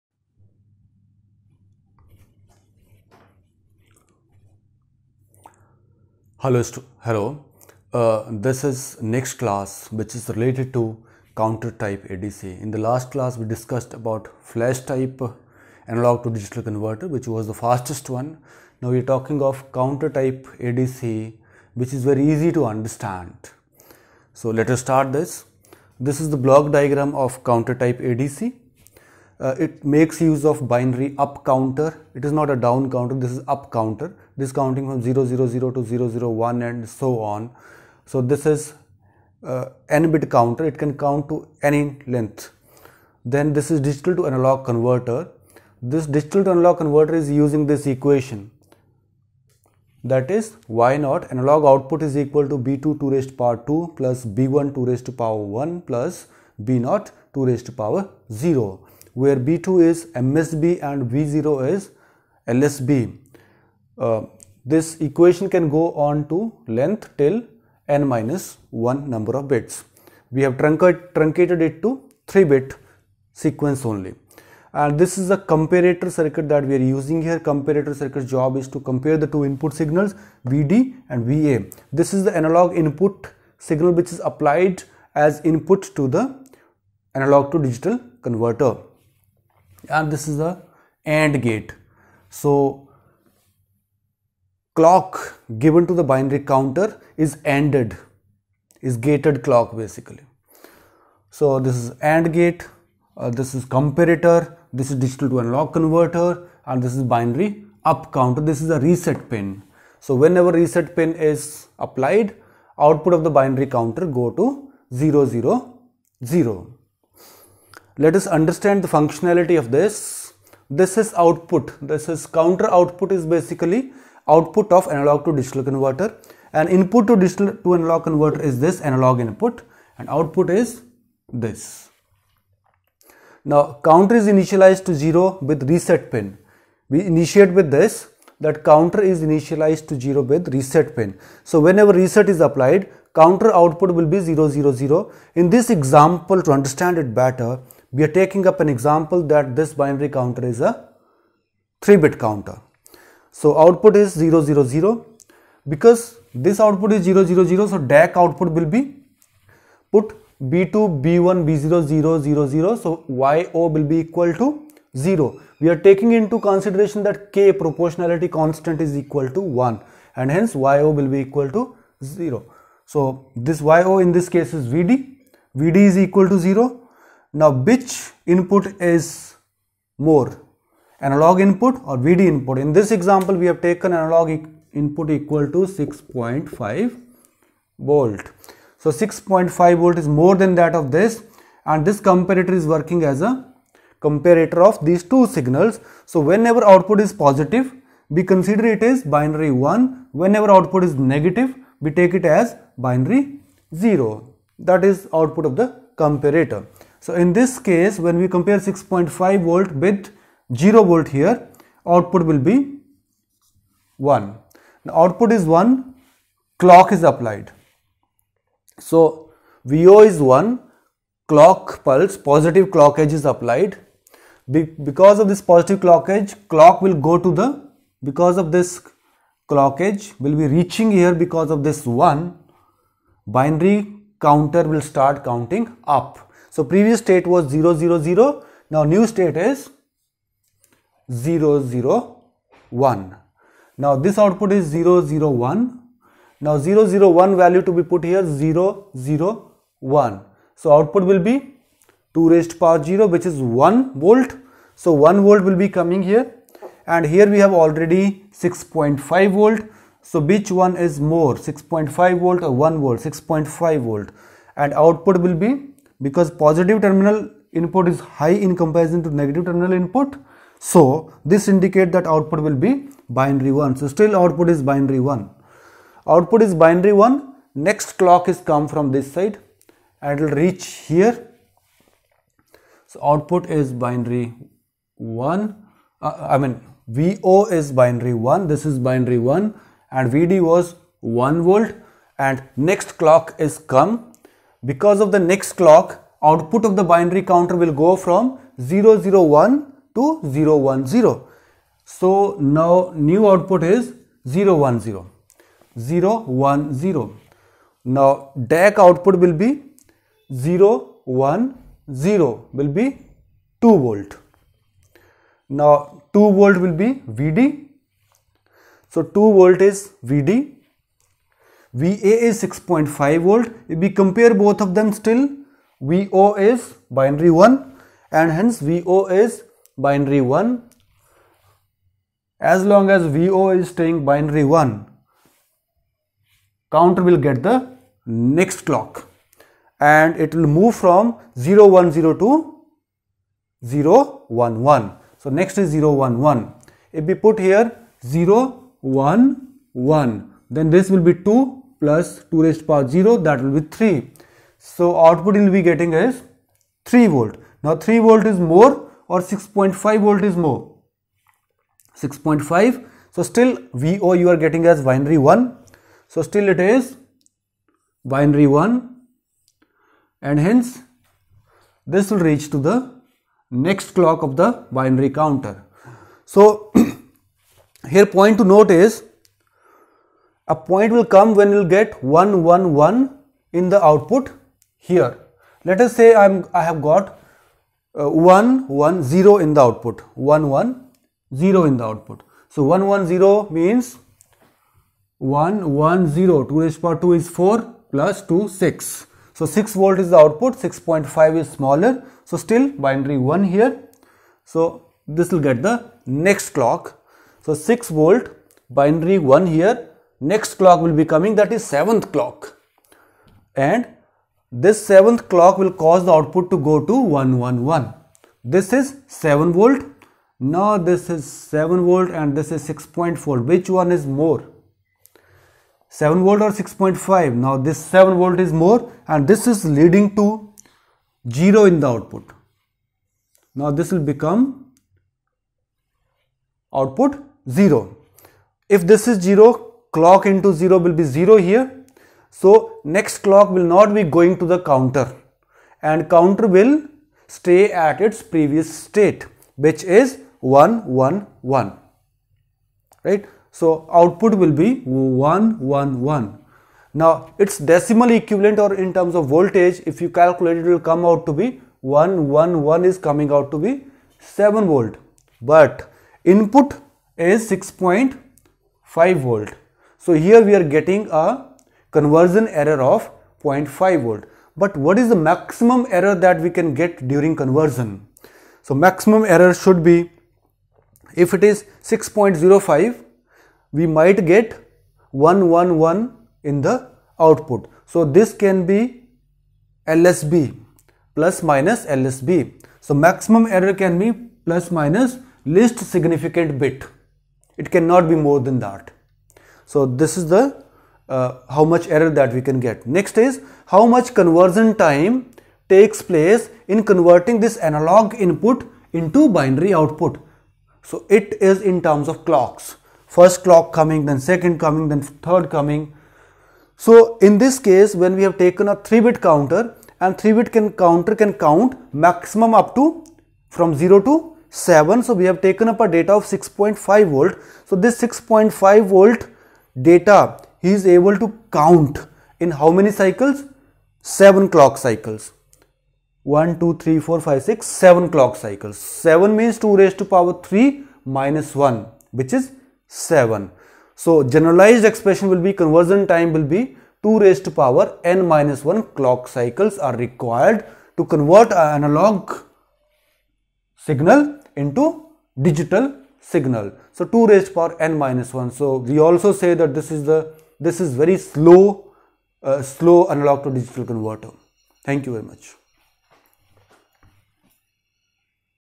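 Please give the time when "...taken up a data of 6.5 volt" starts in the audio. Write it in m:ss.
8:45.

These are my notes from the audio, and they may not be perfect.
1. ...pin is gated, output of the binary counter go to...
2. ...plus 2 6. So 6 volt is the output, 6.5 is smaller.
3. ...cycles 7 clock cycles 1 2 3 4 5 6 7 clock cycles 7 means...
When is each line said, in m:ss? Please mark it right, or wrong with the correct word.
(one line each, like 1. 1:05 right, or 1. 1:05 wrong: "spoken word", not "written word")
1. 1:50 wrong: "applied", not "gated"
2. 6:37 right
3. 8:52 right.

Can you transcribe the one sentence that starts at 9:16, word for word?
So 2 raised to power n minus 1.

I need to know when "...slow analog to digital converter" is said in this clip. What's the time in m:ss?
9:22.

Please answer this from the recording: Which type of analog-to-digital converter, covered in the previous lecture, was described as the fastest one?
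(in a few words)
Flash type.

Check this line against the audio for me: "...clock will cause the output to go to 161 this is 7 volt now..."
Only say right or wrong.
wrong.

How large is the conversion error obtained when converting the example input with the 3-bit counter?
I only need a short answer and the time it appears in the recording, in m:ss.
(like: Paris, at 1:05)
0.5 volts, at 7:53.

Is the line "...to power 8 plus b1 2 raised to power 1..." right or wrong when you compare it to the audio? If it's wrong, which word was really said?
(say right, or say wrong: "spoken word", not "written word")
wrong: "2", not "8".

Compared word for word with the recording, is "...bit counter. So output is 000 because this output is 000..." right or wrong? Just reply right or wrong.
right.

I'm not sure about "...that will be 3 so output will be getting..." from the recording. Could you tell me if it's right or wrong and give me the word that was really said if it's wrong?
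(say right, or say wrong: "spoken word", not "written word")
right.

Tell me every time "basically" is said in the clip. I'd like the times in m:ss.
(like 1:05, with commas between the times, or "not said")
1:39, 2:03.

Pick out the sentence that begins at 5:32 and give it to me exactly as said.
As long as VO is staying binary 1, counter will get the next clock and it will move from 010 to 011.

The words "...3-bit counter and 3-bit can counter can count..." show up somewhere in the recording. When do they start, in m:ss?
8:38.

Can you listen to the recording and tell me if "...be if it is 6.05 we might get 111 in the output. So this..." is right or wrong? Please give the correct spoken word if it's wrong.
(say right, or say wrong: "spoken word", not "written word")
right.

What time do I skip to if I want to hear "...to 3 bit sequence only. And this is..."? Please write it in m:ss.
1:11.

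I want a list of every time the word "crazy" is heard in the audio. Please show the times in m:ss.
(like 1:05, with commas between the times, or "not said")
not said.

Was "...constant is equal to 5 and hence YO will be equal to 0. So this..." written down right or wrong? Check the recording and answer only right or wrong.
wrong.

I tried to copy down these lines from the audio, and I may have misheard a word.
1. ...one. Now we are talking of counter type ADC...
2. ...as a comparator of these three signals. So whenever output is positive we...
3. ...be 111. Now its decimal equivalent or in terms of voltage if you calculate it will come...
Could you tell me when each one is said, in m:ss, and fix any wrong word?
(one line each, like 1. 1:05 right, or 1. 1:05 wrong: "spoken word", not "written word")
1. 0:18 right
2. 3:13 wrong: "two", not "three"
3. 7:34 right.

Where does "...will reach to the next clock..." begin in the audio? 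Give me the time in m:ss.
6:12.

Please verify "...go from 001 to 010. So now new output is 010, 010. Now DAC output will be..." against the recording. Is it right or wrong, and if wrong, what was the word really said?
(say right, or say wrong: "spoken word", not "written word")
right.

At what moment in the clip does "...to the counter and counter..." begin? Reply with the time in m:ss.
7:24.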